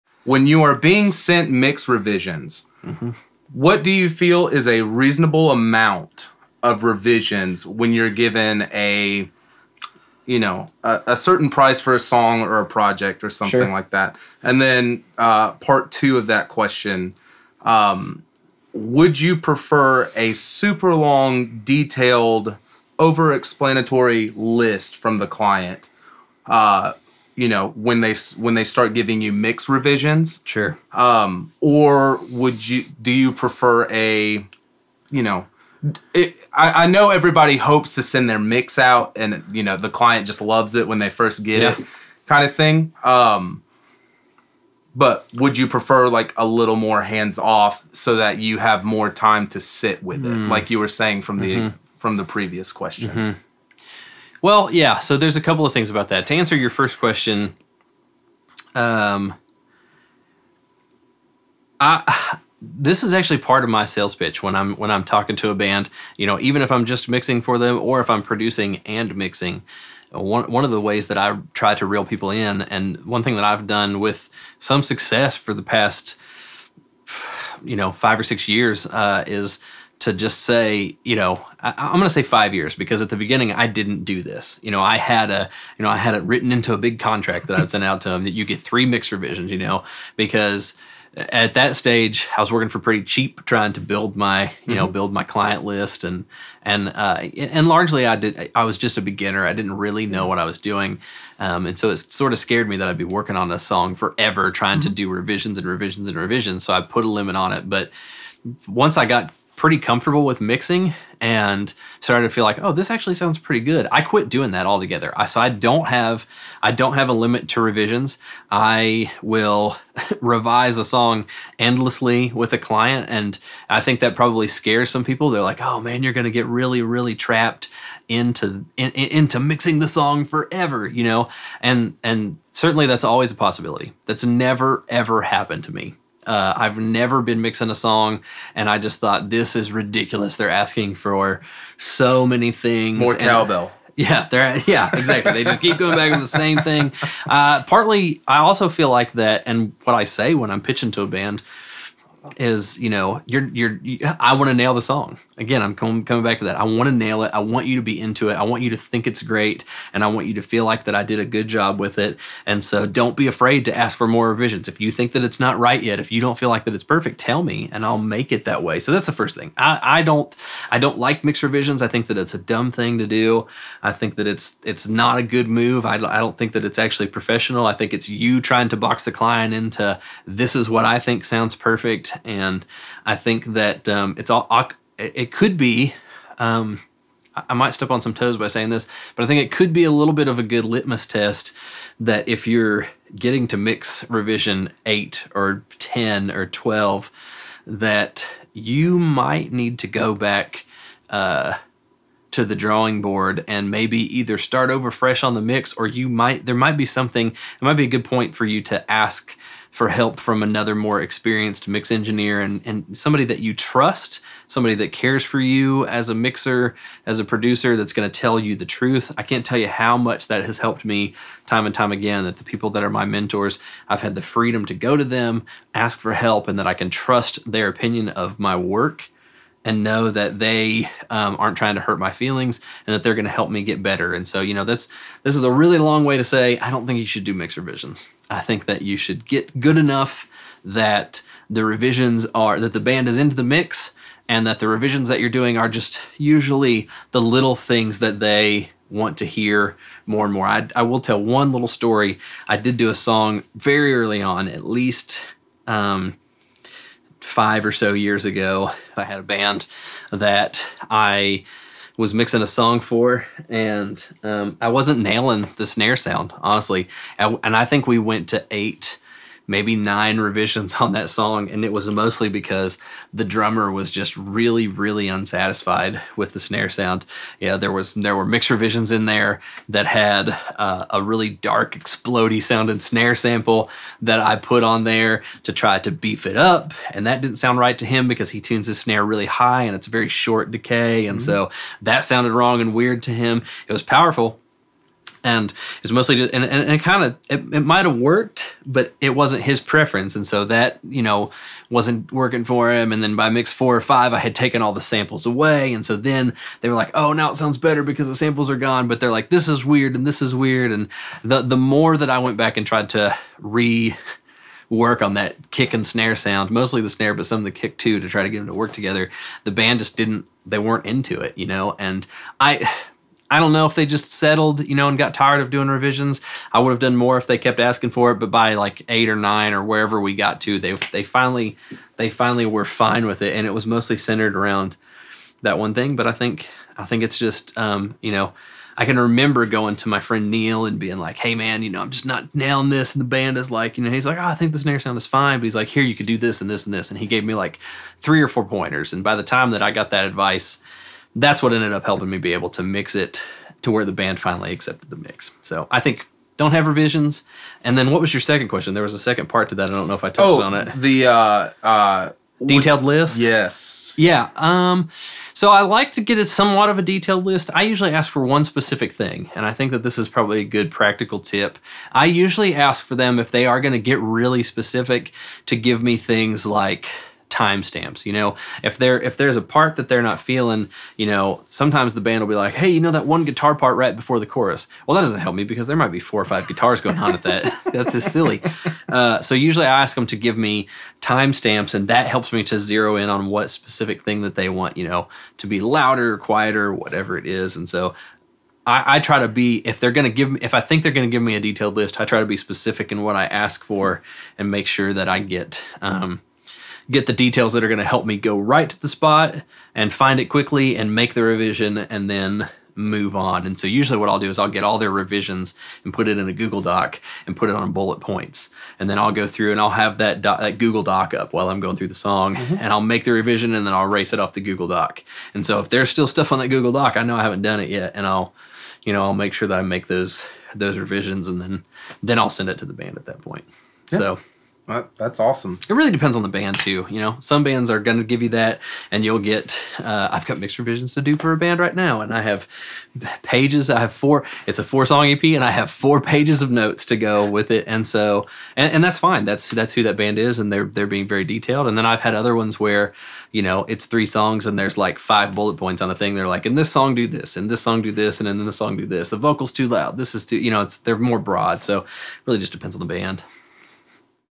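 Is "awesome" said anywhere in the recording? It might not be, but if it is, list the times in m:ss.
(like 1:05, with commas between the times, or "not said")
7:15.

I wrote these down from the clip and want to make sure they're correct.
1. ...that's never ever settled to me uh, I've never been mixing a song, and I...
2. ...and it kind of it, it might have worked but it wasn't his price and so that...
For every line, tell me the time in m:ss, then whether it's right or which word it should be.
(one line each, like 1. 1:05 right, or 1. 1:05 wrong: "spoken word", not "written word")
1. 2:14 wrong: "happened", not "settled"
2. 4:56 wrong: "preference", not "price".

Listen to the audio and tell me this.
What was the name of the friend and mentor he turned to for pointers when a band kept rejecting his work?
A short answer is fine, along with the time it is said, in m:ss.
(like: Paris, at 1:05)
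Neil, at 5:40.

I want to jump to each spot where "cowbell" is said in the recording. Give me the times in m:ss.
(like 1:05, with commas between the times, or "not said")
2:23.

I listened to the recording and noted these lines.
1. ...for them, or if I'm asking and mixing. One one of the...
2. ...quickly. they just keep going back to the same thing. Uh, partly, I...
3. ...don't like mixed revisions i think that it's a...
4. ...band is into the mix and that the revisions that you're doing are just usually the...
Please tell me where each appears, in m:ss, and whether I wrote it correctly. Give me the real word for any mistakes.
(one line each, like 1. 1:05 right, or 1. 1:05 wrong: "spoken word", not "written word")
1. 1:07 wrong: "producing", not "asking"
2. 2:24 wrong: "exactly", not "quickly"
3. 2:50 right
4. 4:02 right.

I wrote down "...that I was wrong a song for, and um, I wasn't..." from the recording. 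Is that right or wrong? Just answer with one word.
wrong.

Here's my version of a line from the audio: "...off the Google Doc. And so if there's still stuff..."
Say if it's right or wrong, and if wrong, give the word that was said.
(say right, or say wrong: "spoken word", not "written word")
right.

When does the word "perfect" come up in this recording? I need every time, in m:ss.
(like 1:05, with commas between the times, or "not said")
2:46, 3:01.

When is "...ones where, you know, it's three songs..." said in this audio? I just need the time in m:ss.
7:32.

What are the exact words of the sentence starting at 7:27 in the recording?
And so, and, and that's fine.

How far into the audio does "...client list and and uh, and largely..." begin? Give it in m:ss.
1:35.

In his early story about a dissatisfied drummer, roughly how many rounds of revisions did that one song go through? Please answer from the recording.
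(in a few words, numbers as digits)
8 or 9.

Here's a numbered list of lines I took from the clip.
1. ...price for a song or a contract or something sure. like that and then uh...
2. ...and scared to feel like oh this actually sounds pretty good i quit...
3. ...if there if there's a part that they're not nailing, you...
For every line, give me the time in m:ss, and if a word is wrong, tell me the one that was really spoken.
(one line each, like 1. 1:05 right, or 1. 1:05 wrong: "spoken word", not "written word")
1. 0:11 wrong: "project", not "contract"
2. 1:51 wrong: "started", not "scared"
3. 6:18 wrong: "feeling", not "nailing".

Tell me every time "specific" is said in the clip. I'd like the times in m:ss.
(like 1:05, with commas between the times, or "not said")
6:08, 6:14, 6:33, 6:42.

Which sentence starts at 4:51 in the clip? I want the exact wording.
so that sounded wrong and weird to him.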